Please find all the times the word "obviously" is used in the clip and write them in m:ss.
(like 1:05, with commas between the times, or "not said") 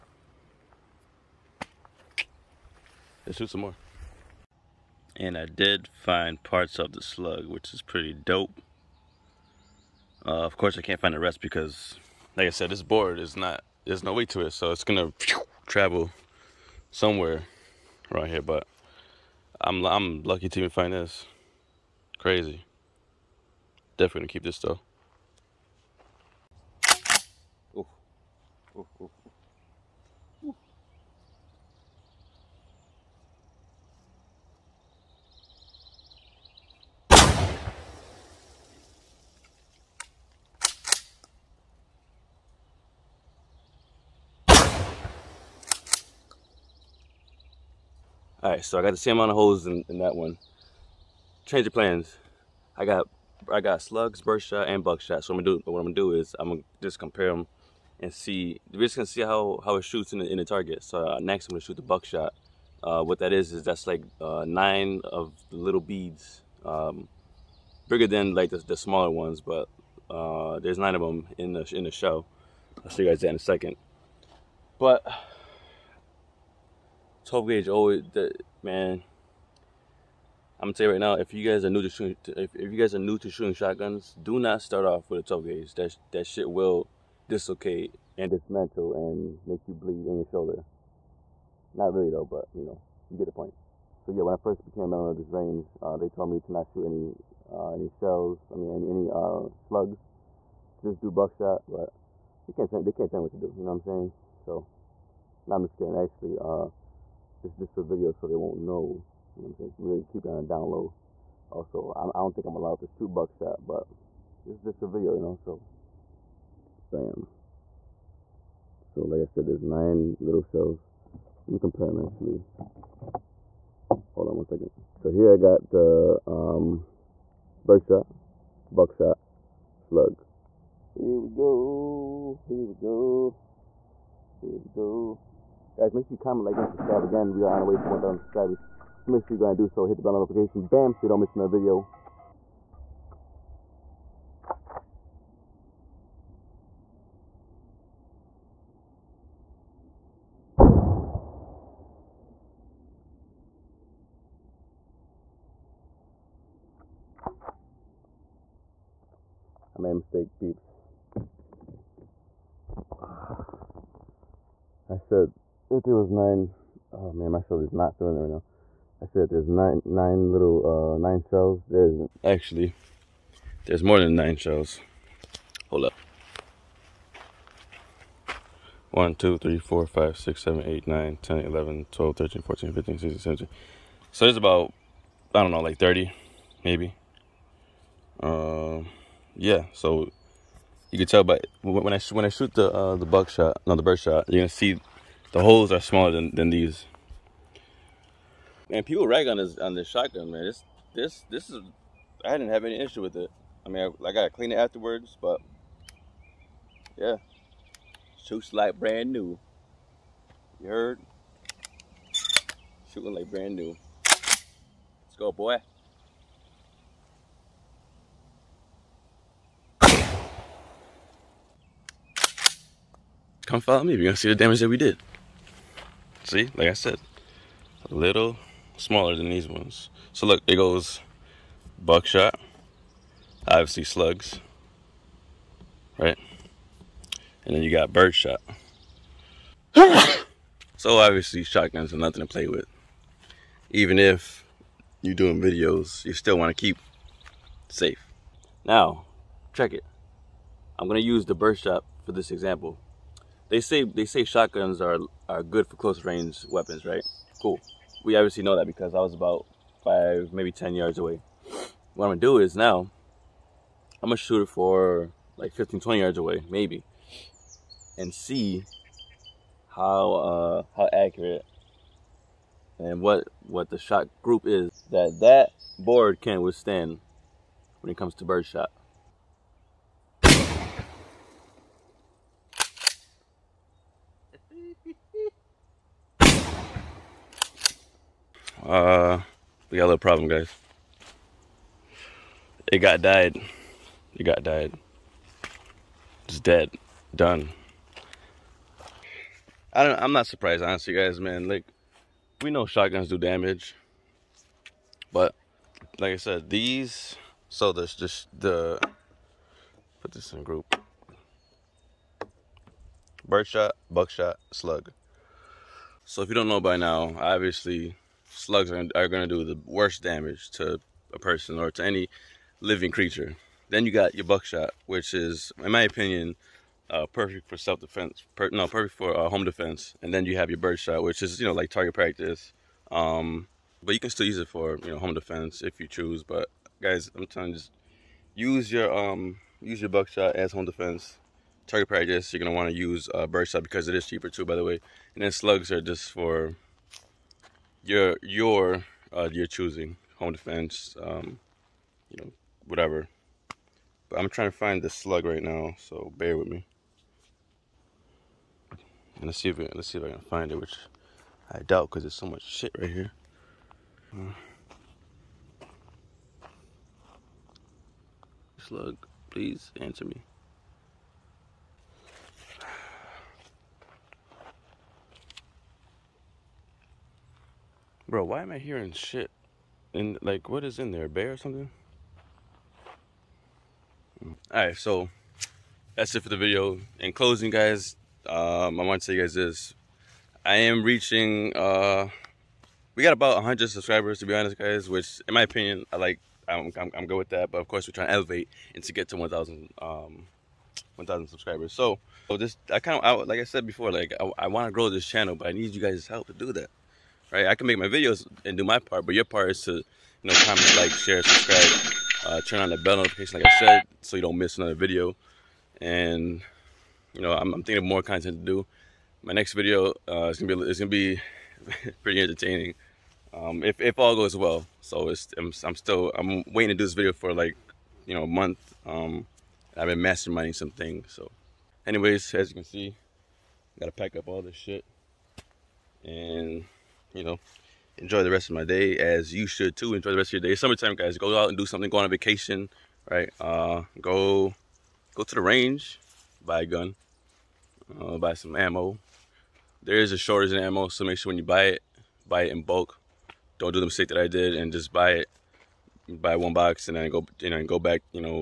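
3:53, 4:00, 4:18, 5:17.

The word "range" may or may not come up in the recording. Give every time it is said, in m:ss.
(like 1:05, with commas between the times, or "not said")
1:35, 4:16, 7:25.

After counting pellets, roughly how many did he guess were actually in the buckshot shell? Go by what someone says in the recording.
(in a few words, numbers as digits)
30.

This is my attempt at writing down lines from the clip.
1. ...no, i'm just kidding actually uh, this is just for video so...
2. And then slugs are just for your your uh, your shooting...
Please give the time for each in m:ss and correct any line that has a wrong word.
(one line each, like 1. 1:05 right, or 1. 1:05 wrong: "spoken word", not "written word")
1. 1:45 right
2. 5:45 wrong: "choosing", not "shooting".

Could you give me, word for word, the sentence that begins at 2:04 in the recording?
So here I got the um, birdshot, buckshot, slug.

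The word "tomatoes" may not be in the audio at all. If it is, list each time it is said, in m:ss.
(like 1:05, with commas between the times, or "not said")
not said.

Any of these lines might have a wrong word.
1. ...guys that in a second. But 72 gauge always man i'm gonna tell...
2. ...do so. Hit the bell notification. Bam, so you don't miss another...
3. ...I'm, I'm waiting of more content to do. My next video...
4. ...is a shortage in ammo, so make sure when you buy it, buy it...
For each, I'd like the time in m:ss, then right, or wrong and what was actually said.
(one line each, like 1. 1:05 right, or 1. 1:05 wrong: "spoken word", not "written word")
1. 1:13 wrong: "12", not "72"
2. 2:19 right
3. 6:57 wrong: "thinking", not "waiting"
4. 7:29 right.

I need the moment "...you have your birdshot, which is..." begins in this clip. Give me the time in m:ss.
5:30.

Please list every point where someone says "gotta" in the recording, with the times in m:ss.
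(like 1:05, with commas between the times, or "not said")
3:24, 7:13.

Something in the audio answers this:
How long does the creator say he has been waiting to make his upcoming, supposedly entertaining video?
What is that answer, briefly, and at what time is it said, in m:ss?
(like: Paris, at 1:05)
a month, at 7:08.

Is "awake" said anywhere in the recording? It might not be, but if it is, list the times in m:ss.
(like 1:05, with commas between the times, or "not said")
not said.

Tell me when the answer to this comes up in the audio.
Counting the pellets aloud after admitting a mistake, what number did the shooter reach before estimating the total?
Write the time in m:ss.
3:03.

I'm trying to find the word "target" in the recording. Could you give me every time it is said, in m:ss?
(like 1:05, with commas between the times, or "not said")
1:00, 5:31, 5:41.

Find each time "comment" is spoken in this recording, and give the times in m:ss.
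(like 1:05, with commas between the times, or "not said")
2:16, 6:50.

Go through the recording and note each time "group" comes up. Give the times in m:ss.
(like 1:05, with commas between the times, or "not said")
4:34, 5:10.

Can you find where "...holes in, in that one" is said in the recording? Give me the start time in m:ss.
0:49.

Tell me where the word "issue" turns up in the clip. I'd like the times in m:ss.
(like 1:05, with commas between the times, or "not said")
3:22.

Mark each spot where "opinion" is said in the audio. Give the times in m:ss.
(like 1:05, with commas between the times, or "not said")
5:25, 6:35.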